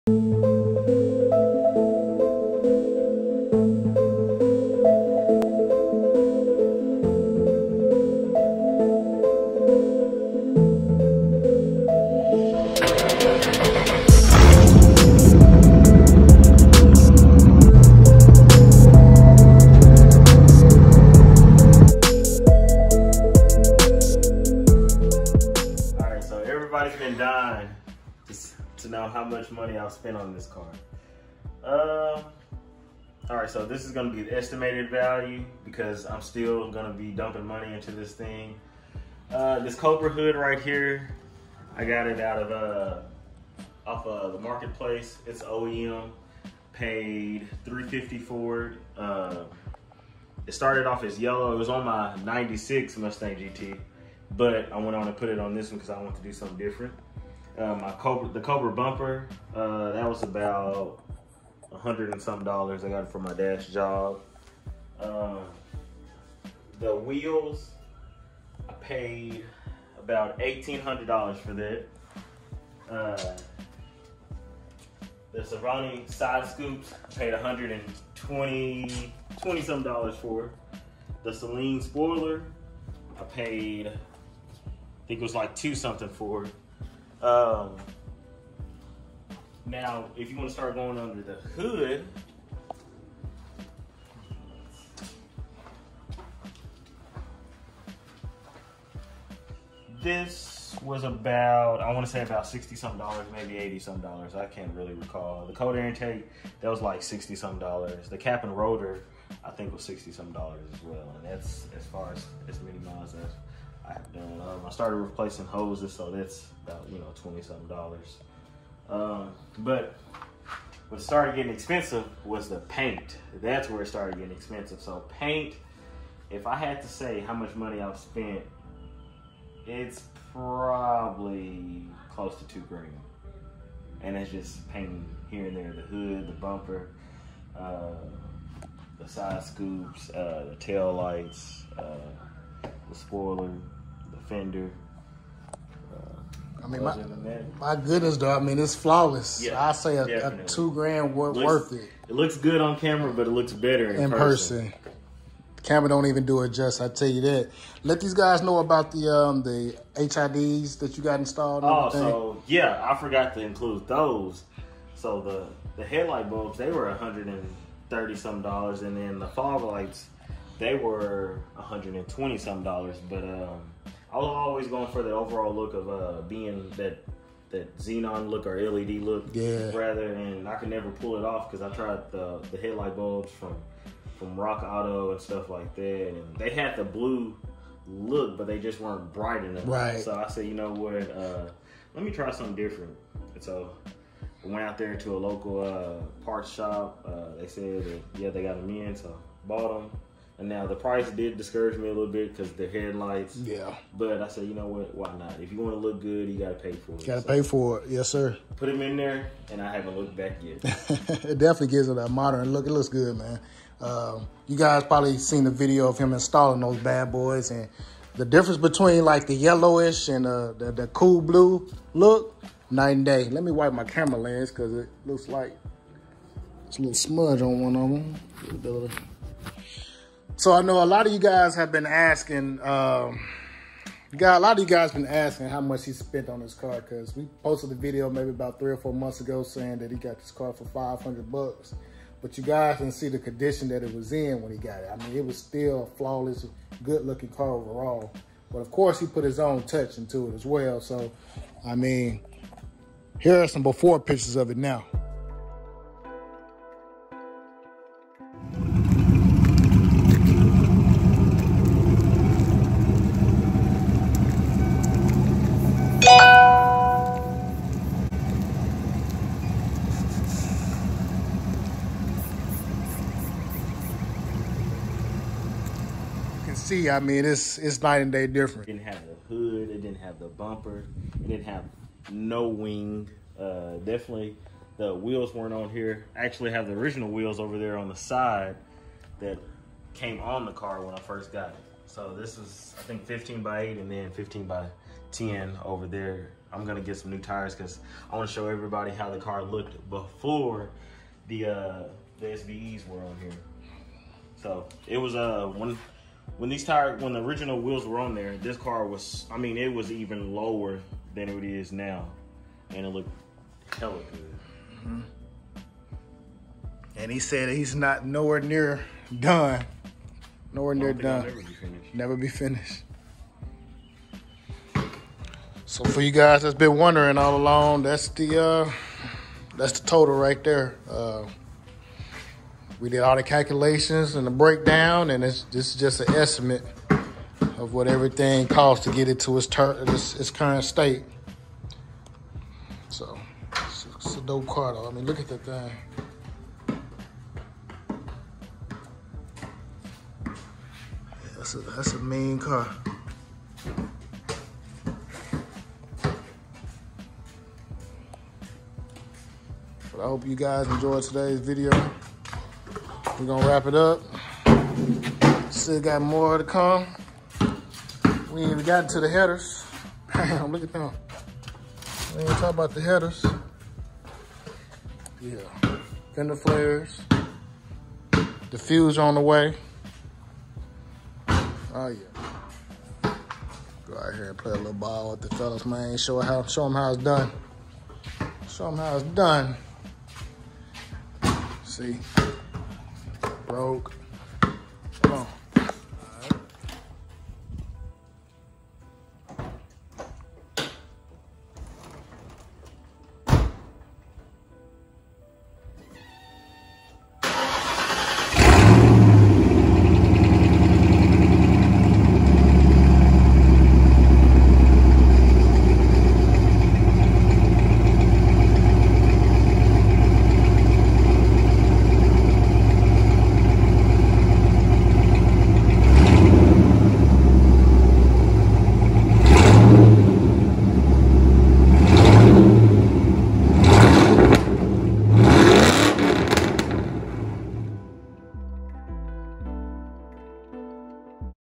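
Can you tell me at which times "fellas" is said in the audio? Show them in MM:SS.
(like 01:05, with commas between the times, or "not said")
06:25.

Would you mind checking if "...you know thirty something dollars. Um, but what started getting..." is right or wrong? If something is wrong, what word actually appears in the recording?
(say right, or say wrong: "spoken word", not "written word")
wrong: "twenty", not "thirty".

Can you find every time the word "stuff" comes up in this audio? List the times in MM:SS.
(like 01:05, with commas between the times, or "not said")
03:05.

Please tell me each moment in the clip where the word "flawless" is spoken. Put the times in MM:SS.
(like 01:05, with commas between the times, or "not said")
02:28, 04:05.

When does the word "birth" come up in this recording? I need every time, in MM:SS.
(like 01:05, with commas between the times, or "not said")
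not said.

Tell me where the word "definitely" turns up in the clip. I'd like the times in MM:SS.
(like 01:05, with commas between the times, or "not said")
03:31, 04:43.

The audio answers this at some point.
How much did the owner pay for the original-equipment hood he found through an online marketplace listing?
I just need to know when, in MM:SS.
00:46.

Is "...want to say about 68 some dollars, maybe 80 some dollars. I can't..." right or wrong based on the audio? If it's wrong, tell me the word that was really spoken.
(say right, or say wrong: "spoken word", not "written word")
wrong: "60", not "68".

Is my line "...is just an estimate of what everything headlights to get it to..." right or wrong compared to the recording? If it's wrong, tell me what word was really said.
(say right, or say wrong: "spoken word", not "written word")
wrong: "costs", not "headlights".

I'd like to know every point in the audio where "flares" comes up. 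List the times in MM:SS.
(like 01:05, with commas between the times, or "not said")
06:16.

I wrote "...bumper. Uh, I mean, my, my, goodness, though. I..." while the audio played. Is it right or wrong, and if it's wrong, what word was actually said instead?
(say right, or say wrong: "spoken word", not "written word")
wrong: "fender", not "bumper".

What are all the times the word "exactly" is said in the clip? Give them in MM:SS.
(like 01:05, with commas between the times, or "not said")
not said.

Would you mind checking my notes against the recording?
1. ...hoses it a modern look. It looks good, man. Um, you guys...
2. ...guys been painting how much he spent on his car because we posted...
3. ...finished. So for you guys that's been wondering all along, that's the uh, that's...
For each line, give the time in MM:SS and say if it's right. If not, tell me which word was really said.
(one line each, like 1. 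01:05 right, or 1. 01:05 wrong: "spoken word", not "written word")
1. 03:31 wrong: "gives", not "hoses"
2. 03:54 wrong: "asking", not "painting"
3. 05:22 right.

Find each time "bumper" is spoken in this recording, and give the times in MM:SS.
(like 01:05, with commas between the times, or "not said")
00:58, 02:16, 04:40.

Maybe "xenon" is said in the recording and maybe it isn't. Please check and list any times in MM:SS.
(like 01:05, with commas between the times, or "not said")
02:57.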